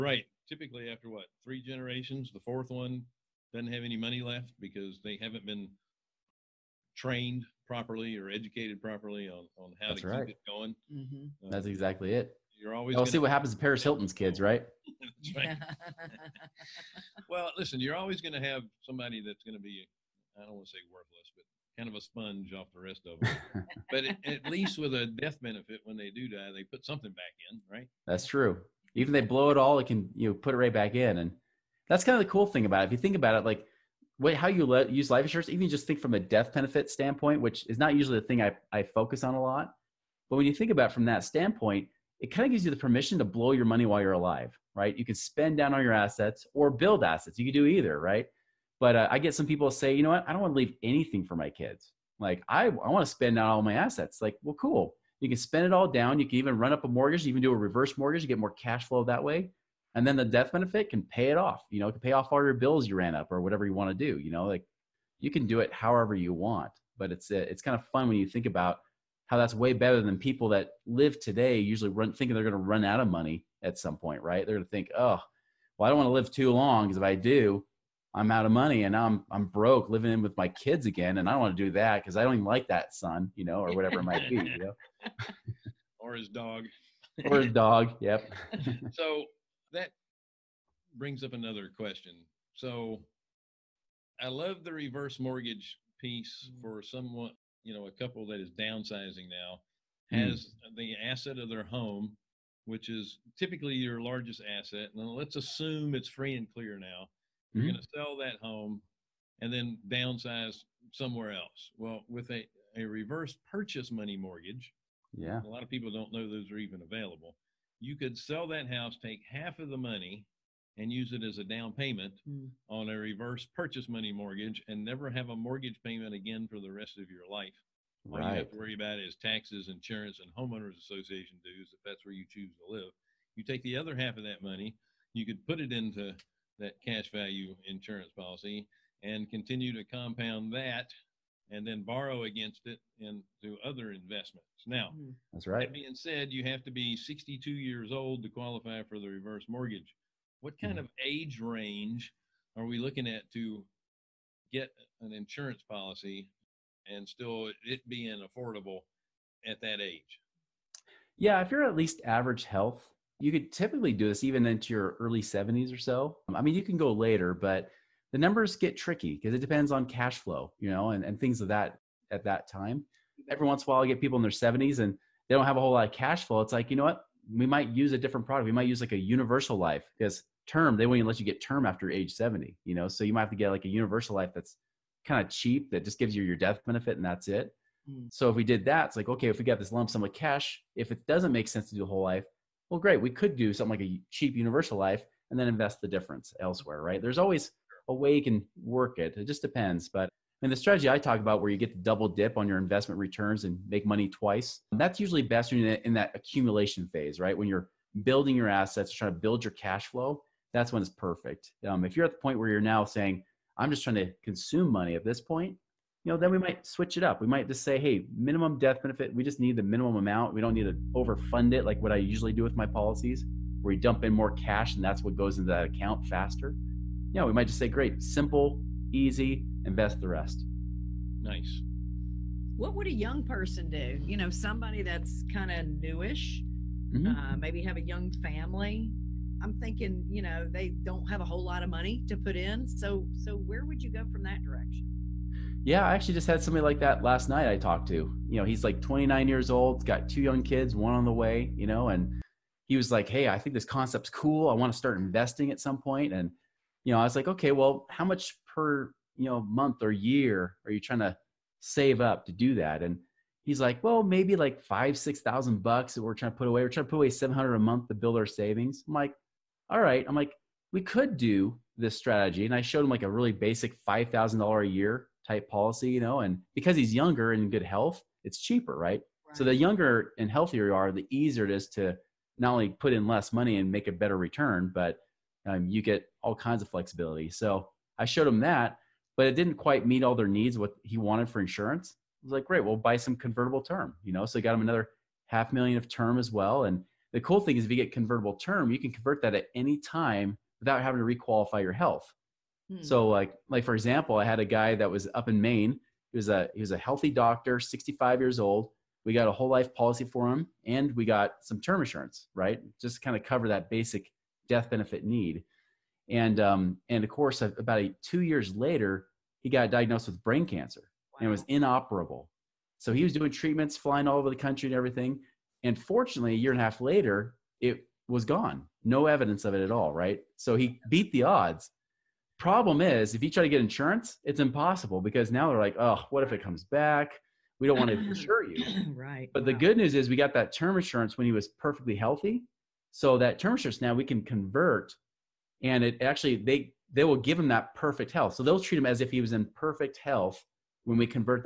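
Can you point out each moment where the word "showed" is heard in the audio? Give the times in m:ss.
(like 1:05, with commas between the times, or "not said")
4:32, 4:48.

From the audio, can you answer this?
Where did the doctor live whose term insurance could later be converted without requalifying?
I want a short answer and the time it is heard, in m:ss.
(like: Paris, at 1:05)
Maine, at 5:05.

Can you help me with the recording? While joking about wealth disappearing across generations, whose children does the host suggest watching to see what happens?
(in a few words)
Paris Hilton.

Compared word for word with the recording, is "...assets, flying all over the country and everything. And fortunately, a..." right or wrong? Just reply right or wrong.
wrong.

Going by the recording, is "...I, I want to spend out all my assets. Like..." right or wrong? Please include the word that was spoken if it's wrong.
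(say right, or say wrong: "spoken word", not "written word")
right.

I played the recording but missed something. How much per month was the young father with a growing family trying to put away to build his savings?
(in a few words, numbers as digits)
$700.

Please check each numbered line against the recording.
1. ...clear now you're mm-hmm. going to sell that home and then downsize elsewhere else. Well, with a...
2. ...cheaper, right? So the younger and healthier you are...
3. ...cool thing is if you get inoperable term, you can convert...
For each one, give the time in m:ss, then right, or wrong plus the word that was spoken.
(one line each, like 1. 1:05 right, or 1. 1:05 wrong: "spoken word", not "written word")
1. 1:46 wrong: "somewhere", not "elsewhere"
2. 4:38 right
3. 4:57 wrong: "convertible", not "inoperable".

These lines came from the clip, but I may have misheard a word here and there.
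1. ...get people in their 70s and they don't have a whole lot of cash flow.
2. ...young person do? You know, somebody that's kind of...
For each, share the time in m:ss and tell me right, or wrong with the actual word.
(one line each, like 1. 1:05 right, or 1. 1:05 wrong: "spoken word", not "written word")
1. 2:53 right
2. 3:52 right.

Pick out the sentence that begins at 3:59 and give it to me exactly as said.
I'm thinking, you know, they don't have a whole lot of money to put in.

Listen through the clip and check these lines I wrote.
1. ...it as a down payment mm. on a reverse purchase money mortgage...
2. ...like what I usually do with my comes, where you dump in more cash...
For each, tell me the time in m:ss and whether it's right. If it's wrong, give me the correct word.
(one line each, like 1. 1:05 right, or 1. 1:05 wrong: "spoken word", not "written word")
1. 2:01 right
2. 3:41 wrong: "policies", not "comes".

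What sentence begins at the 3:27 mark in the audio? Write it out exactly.
When you're building your assets, trying to build your cash flow, that's when it's perfect.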